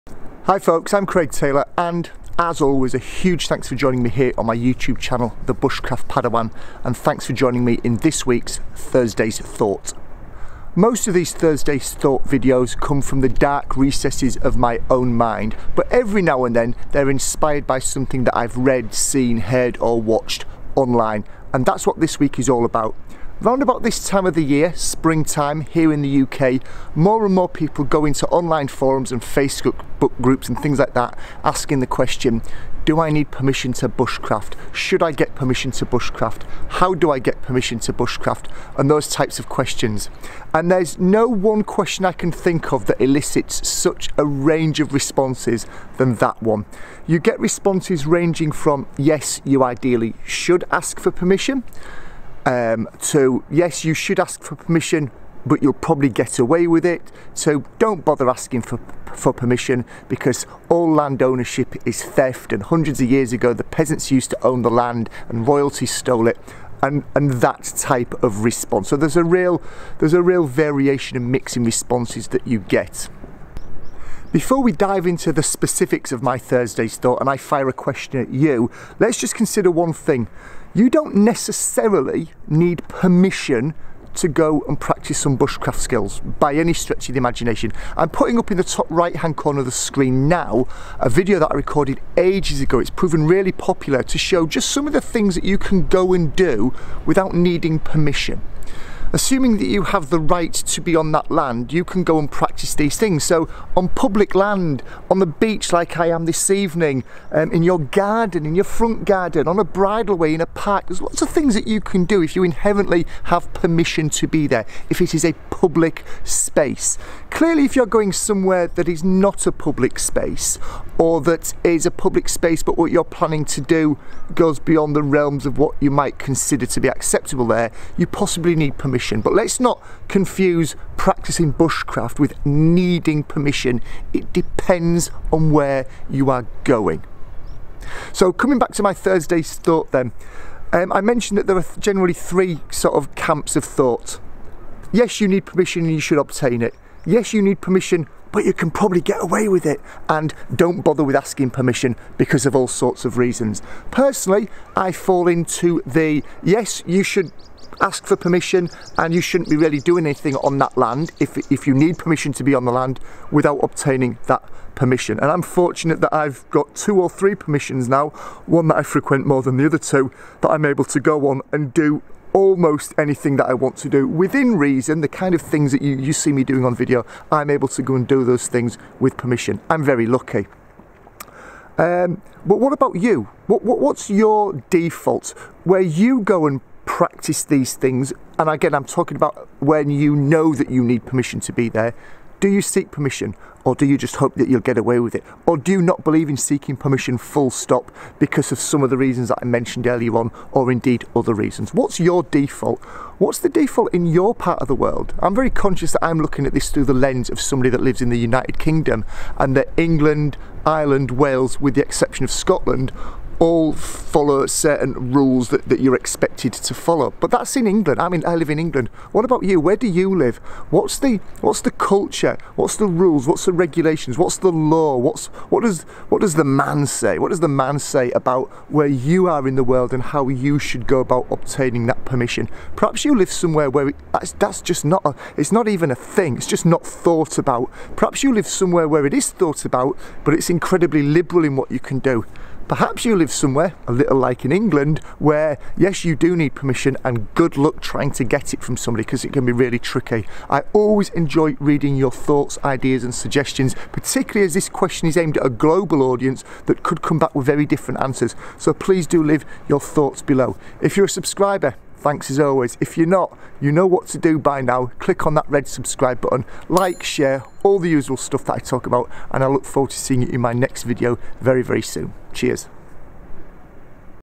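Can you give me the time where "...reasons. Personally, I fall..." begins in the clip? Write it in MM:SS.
02:33.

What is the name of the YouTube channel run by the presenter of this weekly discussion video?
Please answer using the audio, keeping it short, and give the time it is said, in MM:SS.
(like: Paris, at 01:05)
The Bushcraft Padawan, at 00:05.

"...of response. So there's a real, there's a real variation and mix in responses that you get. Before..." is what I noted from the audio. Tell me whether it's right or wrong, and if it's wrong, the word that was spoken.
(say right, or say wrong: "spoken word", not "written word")
right.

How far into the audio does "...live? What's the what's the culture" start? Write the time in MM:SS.
03:40.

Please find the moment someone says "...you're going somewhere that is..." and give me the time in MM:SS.
01:57.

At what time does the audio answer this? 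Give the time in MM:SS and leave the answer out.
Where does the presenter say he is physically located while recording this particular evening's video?
01:45.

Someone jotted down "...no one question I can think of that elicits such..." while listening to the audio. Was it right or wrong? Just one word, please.
right.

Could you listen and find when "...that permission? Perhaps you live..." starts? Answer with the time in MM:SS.
03:51.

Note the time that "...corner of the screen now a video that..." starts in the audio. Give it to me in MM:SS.
01:29.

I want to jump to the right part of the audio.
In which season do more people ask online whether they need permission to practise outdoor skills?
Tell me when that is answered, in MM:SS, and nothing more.
00:24.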